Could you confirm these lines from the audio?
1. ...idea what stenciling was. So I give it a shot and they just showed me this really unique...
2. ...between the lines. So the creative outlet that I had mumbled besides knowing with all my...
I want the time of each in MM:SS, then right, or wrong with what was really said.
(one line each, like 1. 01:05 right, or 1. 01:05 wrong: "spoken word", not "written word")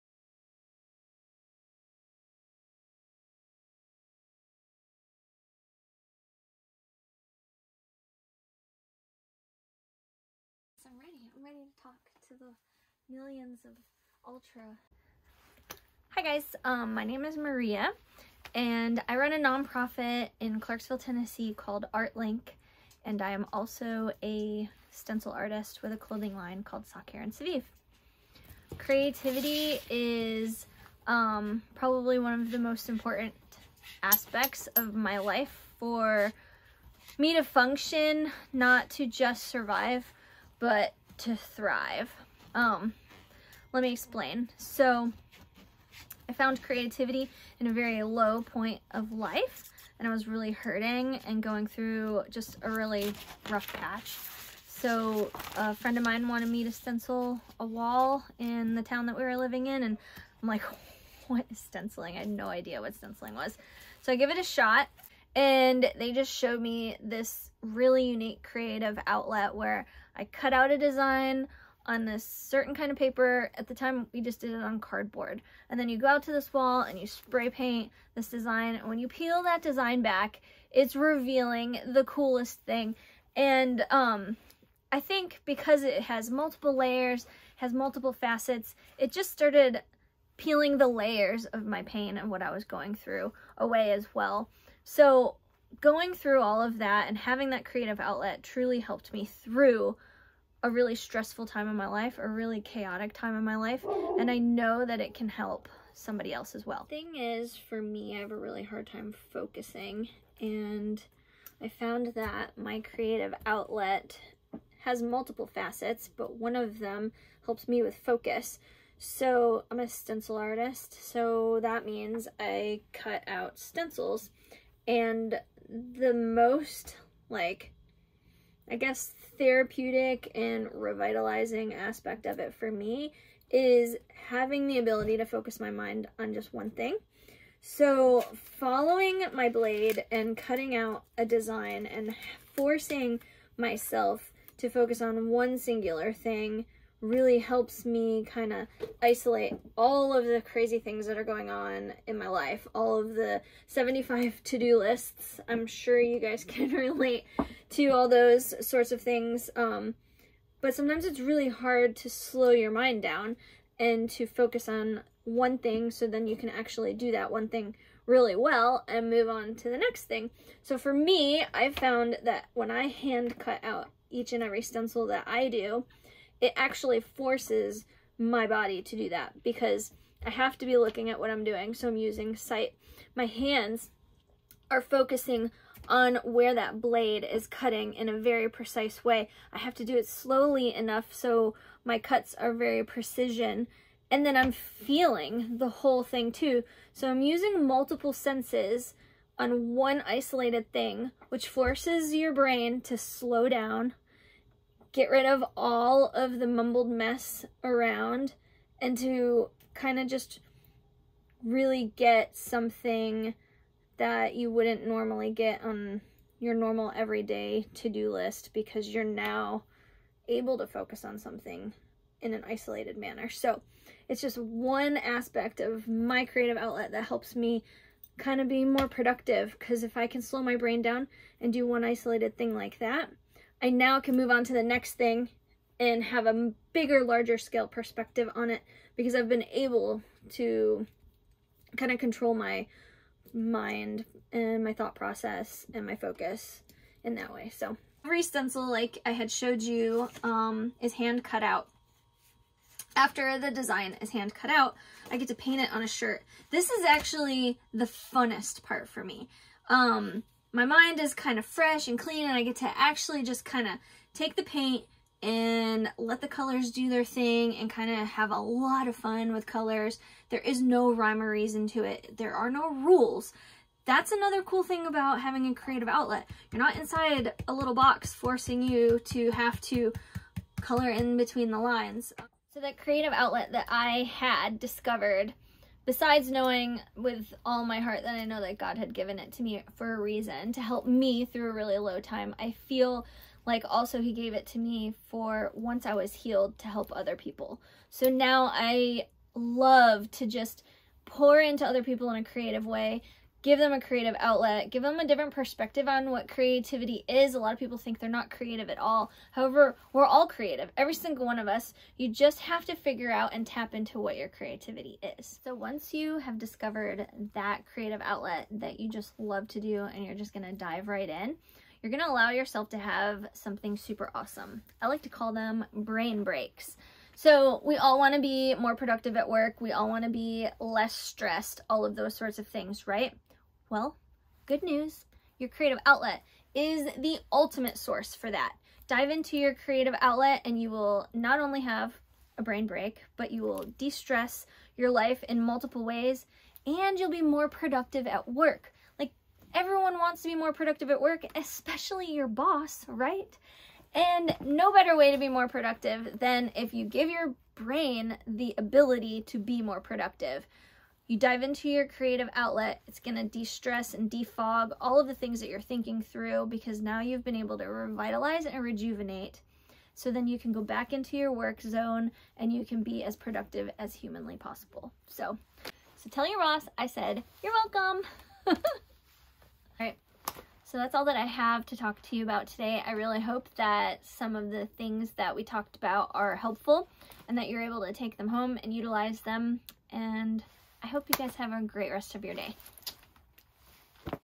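1. 01:02 right
2. 04:41 wrong: "discovered", not "mumbled".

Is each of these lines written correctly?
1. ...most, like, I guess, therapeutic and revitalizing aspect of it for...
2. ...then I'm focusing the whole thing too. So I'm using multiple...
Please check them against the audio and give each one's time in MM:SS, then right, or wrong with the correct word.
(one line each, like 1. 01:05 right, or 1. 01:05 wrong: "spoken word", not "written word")
1. 02:06 right
2. 03:14 wrong: "feeling", not "focusing".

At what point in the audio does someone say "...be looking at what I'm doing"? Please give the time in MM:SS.
03:00.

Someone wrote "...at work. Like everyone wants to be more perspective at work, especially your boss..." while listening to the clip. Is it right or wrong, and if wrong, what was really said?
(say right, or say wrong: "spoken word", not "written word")
wrong: "productive", not "perspective".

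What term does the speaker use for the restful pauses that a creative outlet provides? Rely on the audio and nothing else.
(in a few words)
Brain breaks.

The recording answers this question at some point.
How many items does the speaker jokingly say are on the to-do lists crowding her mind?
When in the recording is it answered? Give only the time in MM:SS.
02:33.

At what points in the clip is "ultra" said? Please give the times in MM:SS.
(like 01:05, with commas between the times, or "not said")
00:14.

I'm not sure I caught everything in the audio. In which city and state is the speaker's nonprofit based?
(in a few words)
Clarksville, Tennessee.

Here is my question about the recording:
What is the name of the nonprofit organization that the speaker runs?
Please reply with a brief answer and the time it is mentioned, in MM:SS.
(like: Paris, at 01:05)
ArtLink, at 00:21.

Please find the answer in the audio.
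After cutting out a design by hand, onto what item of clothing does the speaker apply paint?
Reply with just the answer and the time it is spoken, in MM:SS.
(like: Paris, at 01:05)
A shirt, at 04:15.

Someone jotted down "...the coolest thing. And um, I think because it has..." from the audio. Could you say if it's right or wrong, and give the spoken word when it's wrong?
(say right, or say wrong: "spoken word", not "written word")
right.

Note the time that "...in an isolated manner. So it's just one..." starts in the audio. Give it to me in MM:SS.
03:42.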